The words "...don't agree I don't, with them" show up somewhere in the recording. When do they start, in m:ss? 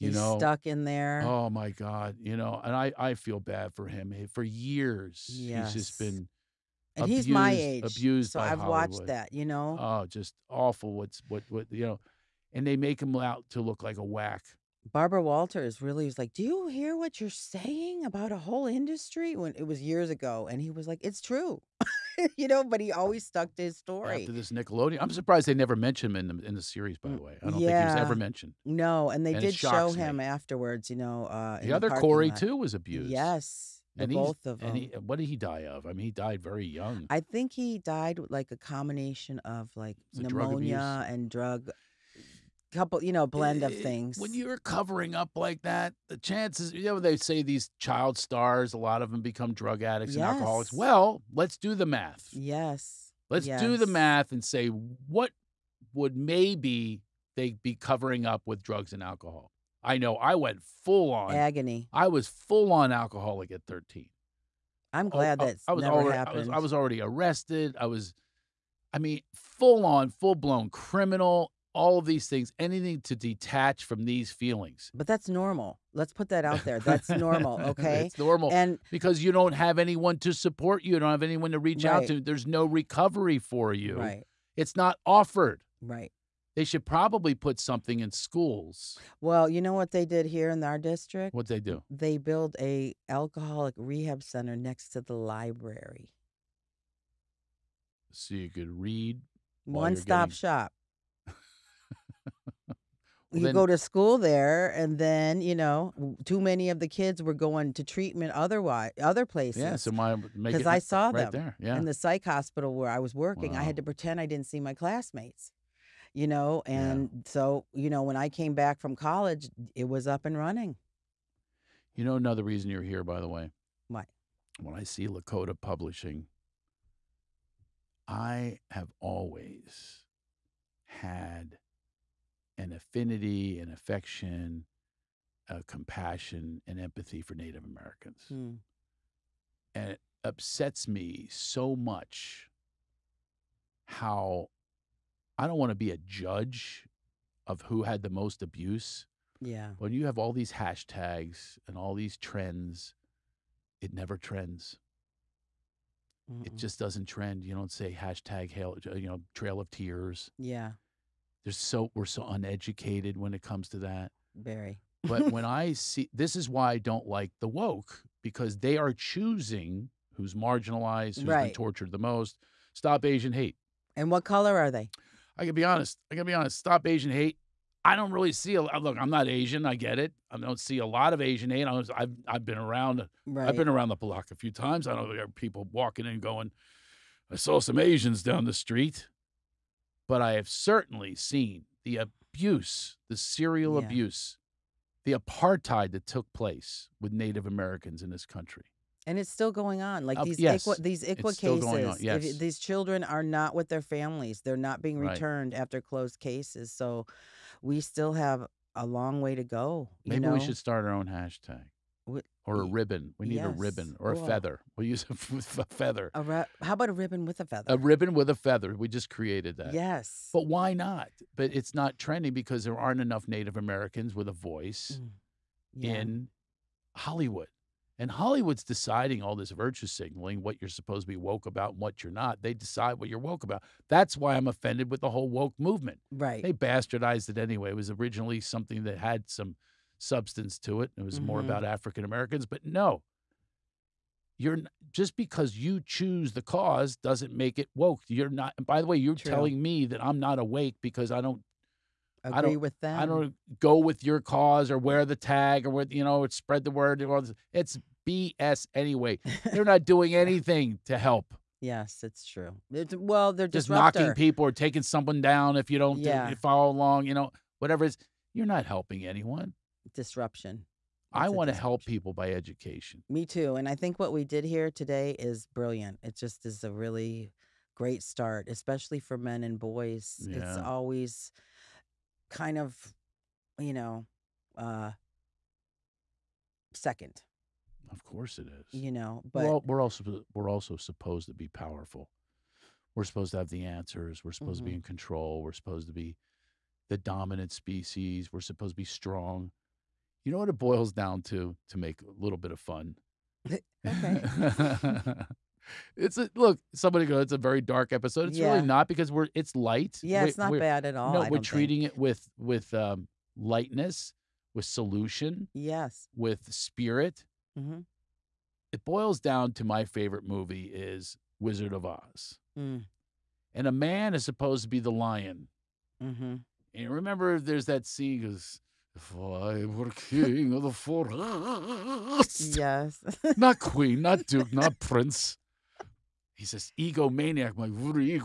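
4:11.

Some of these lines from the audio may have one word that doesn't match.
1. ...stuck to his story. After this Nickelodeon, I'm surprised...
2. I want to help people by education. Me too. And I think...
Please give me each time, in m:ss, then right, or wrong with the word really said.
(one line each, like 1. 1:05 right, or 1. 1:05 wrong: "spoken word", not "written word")
1. 0:23 right
2. 4:31 right.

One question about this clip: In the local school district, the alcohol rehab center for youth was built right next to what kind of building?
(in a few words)
The library.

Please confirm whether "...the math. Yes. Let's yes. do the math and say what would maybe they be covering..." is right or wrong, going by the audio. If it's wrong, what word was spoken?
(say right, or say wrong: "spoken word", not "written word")
right.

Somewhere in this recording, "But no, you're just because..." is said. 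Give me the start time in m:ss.
4:02.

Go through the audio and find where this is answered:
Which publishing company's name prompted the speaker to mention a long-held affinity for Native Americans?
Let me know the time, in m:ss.
2:05.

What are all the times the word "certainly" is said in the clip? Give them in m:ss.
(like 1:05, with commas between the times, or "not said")
3:10.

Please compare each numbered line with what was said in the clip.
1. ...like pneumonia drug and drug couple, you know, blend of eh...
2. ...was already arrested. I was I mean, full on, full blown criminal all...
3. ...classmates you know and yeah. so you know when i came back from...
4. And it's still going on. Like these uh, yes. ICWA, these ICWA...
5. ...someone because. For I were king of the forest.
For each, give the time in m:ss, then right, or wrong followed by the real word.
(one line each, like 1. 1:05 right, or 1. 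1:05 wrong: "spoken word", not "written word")
1. 0:39 right
2. 1:06 right
3. 1:54 right
4. 3:19 right
5. 5:27 wrong: "scene", not "someone".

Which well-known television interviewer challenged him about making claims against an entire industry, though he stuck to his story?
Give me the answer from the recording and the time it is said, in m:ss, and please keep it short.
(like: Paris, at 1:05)
Barbara Walters, at 0:14.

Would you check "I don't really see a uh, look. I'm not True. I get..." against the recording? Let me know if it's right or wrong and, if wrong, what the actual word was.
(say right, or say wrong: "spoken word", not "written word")
wrong: "Asian", not "True".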